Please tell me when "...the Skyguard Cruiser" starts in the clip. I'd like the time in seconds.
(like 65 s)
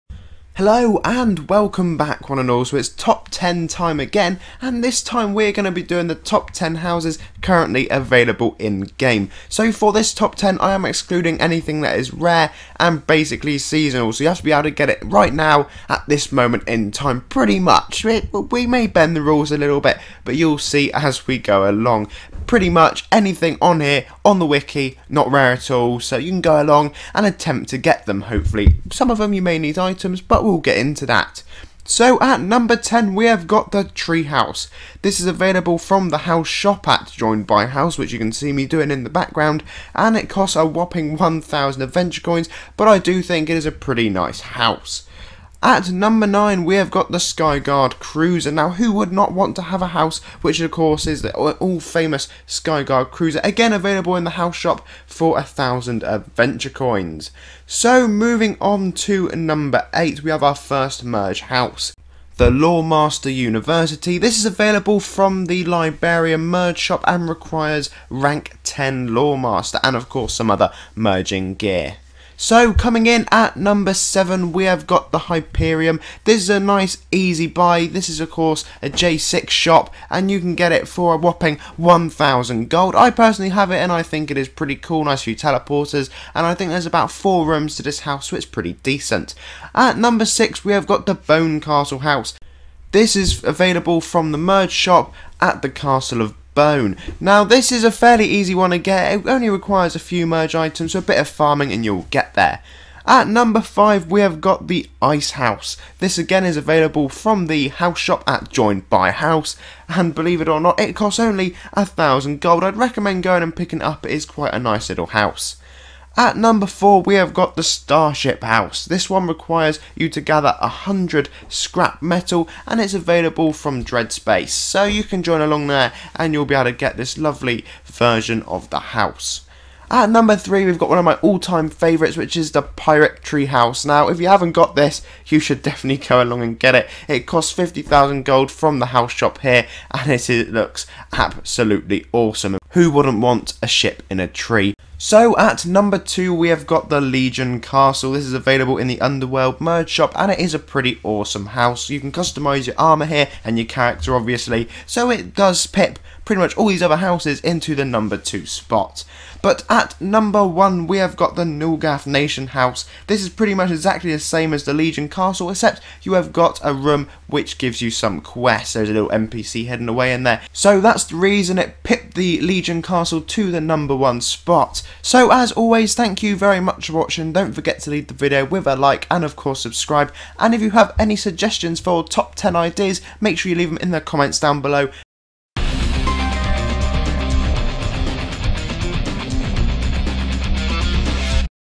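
47 s.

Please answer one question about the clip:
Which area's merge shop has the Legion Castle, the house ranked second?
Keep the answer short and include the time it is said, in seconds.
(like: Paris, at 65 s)
Underworld, at 149 s.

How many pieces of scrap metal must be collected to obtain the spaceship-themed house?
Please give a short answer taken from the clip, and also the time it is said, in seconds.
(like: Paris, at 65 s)
100, at 120 s.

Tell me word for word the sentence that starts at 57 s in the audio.
So, moving on to number 8, we have our first merge house the Loremaster University.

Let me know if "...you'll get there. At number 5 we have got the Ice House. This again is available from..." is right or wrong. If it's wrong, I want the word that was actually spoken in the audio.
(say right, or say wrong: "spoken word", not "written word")
right.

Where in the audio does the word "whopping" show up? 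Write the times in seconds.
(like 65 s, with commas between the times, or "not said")
40 s, 81 s.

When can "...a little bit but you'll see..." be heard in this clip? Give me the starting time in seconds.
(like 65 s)
19 s.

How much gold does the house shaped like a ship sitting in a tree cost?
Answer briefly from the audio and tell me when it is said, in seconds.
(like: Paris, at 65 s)
50,000 gold, at 137 s.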